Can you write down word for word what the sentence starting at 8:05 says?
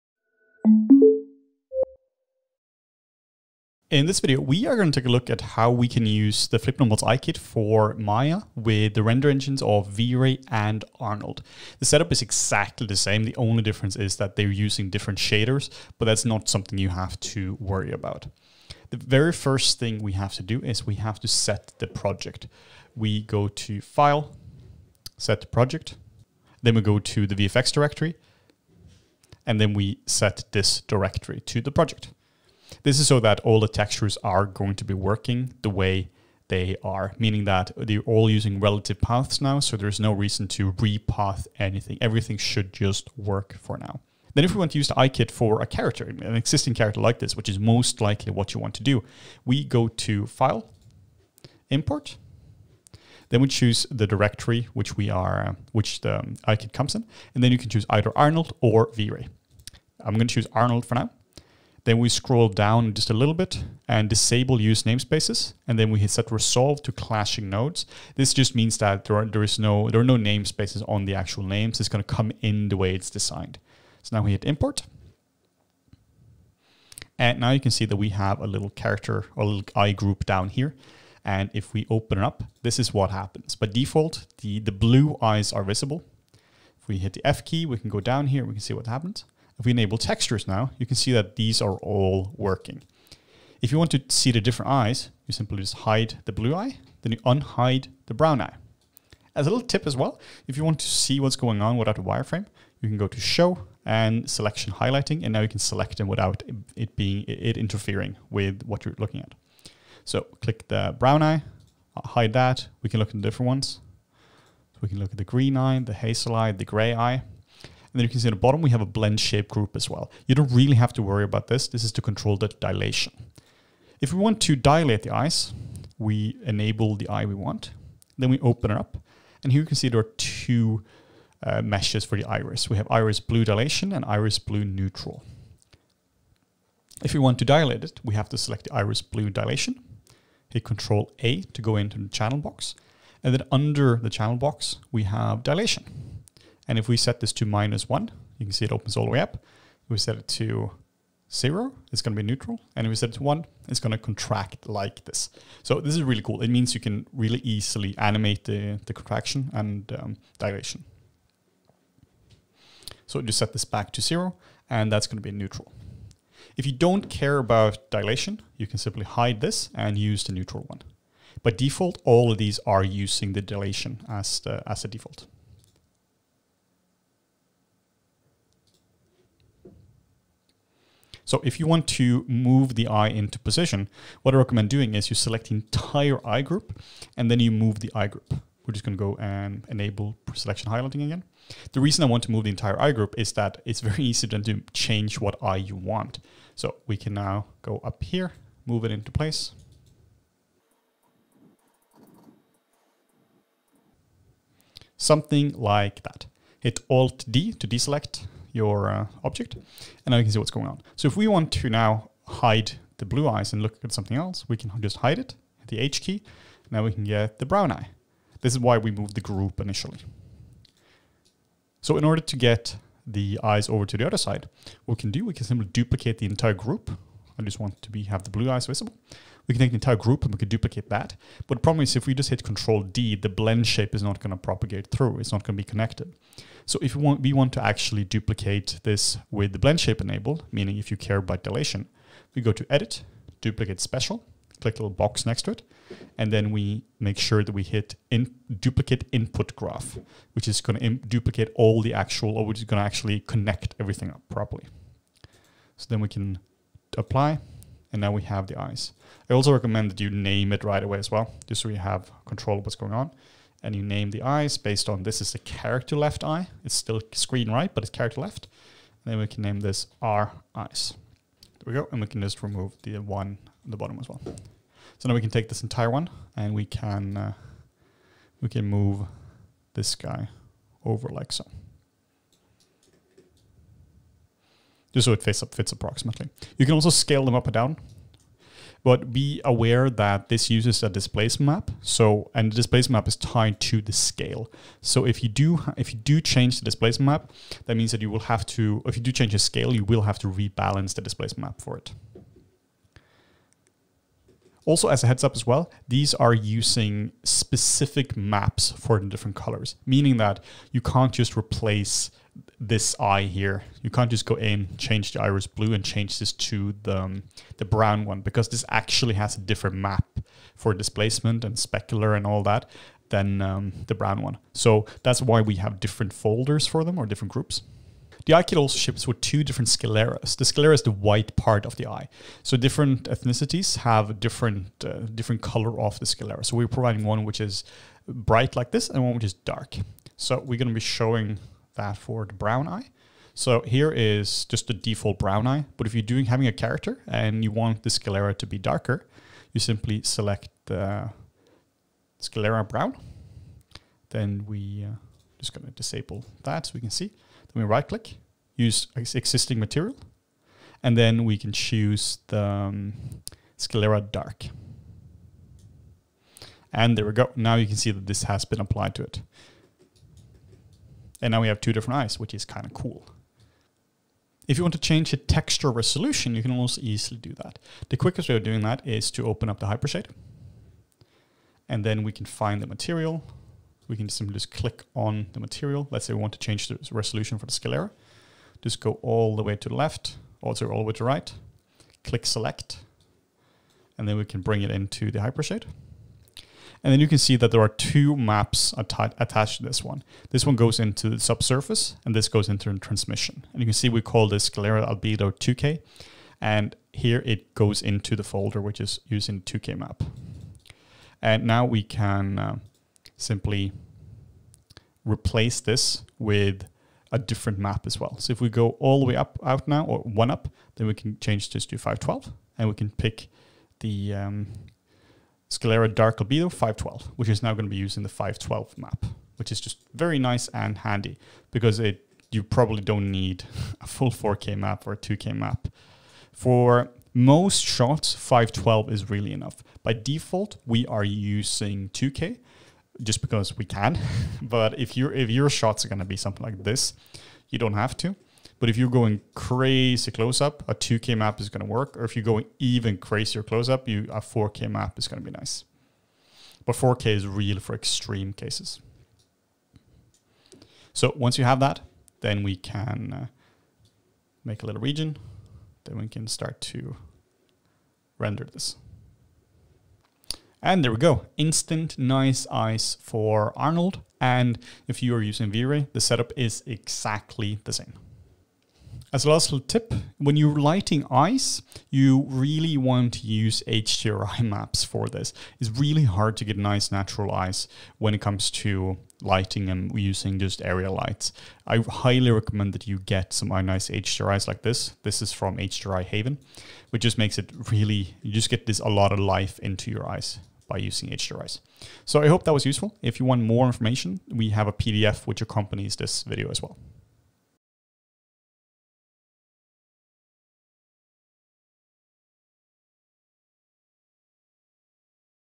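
It's really hard to get nice natural eyes when it comes to lighting and using just area lights.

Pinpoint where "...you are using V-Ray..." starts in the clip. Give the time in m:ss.
7:55.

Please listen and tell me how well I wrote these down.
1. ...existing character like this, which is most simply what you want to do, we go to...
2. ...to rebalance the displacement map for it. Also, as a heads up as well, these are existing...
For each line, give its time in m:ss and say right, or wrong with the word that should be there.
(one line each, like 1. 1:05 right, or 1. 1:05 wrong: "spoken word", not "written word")
1. 0:46 wrong: "likely", not "simply"
2. 5:00 wrong: "using", not "existing".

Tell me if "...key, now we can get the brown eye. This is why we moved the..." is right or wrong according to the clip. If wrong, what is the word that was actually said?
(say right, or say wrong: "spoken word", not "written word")
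right.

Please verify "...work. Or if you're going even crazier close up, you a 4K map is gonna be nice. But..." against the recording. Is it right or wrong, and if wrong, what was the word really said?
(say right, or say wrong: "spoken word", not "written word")
right.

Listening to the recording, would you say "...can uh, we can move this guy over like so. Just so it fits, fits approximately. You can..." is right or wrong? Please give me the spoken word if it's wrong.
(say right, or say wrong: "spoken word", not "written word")
right.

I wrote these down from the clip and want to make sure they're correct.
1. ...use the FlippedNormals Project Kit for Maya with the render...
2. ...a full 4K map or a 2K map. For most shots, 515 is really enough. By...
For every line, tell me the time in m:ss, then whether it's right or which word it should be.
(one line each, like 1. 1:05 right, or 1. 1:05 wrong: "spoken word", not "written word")
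1. 0:06 wrong: "Eye", not "Project"
2. 7:13 wrong: "512", not "515".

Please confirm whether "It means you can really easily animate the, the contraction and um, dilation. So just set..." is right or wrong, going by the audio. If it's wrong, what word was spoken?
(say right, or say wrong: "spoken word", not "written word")
right.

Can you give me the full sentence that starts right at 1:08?
This just means that there are, there is no, there are no namespaces on the actual names.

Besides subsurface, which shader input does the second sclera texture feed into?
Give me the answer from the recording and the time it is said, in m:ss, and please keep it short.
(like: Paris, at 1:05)
transmission, at 6:42.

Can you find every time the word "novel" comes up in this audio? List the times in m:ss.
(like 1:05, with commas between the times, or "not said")
not said.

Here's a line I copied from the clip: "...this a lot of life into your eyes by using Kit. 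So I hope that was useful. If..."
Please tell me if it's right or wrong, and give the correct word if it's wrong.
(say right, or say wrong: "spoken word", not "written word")
wrong: "HDRIs", not "Kit".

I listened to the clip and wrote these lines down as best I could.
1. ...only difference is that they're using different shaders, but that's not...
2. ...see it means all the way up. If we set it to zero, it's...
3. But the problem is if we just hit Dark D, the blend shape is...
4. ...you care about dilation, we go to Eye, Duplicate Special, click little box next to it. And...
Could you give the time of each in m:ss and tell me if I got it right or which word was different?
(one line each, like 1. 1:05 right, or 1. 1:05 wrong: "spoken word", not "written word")
1. 0:13 right
2. 2:28 wrong: "opens", not "means"
3. 3:51 wrong: "Control", not "Dark"
4. 4:00 wrong: "Edit", not "Eye".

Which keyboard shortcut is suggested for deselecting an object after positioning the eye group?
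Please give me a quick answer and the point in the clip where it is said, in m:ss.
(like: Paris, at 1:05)
Alt D, at 3:26.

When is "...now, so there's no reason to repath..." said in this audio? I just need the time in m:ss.
0:39.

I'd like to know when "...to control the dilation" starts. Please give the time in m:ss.
2:01.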